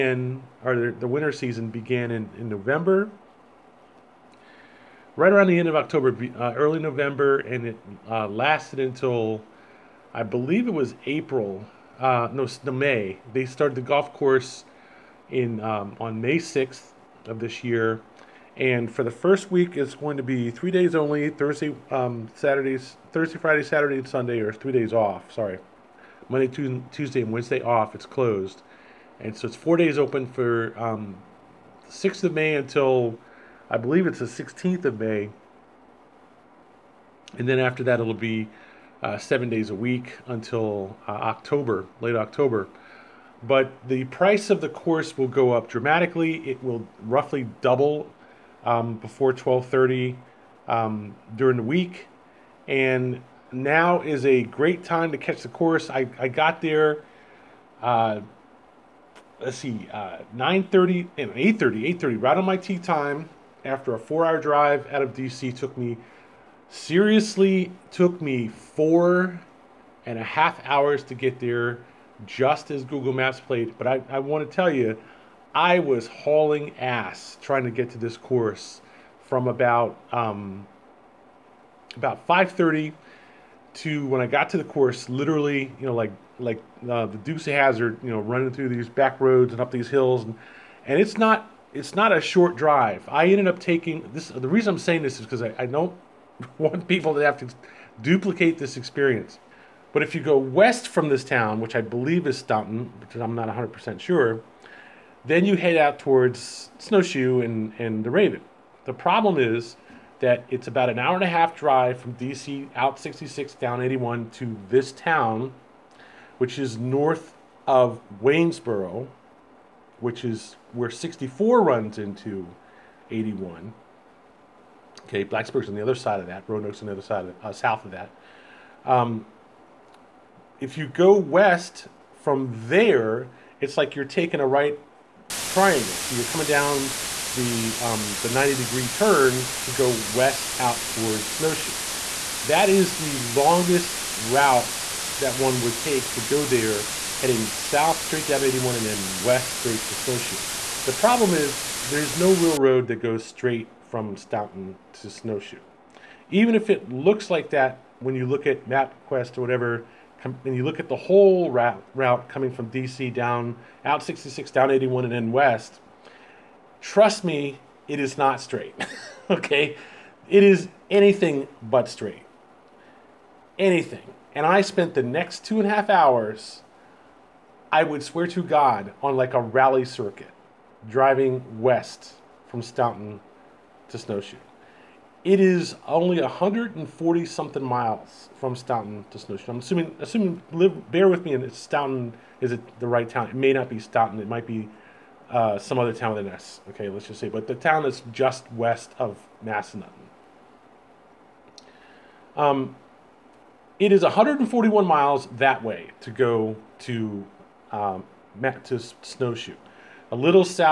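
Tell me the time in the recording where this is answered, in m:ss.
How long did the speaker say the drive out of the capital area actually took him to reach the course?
1:08.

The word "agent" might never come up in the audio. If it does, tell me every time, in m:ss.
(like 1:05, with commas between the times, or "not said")
not said.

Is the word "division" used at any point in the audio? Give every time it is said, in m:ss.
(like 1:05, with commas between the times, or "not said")
not said.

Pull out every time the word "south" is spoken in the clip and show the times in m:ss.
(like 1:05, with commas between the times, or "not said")
2:07, 2:27.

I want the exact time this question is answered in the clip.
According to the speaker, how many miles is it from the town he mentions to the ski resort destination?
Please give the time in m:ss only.
3:24.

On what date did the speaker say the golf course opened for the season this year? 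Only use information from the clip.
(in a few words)
May 6.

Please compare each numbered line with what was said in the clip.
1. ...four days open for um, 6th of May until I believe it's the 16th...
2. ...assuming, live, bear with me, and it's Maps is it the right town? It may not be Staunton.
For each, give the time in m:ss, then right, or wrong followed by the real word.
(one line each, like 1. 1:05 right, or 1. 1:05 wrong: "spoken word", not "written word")
1. 0:29 right
2. 3:09 wrong: "Staunton", not "Maps".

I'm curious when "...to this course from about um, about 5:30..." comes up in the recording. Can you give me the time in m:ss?
1:17.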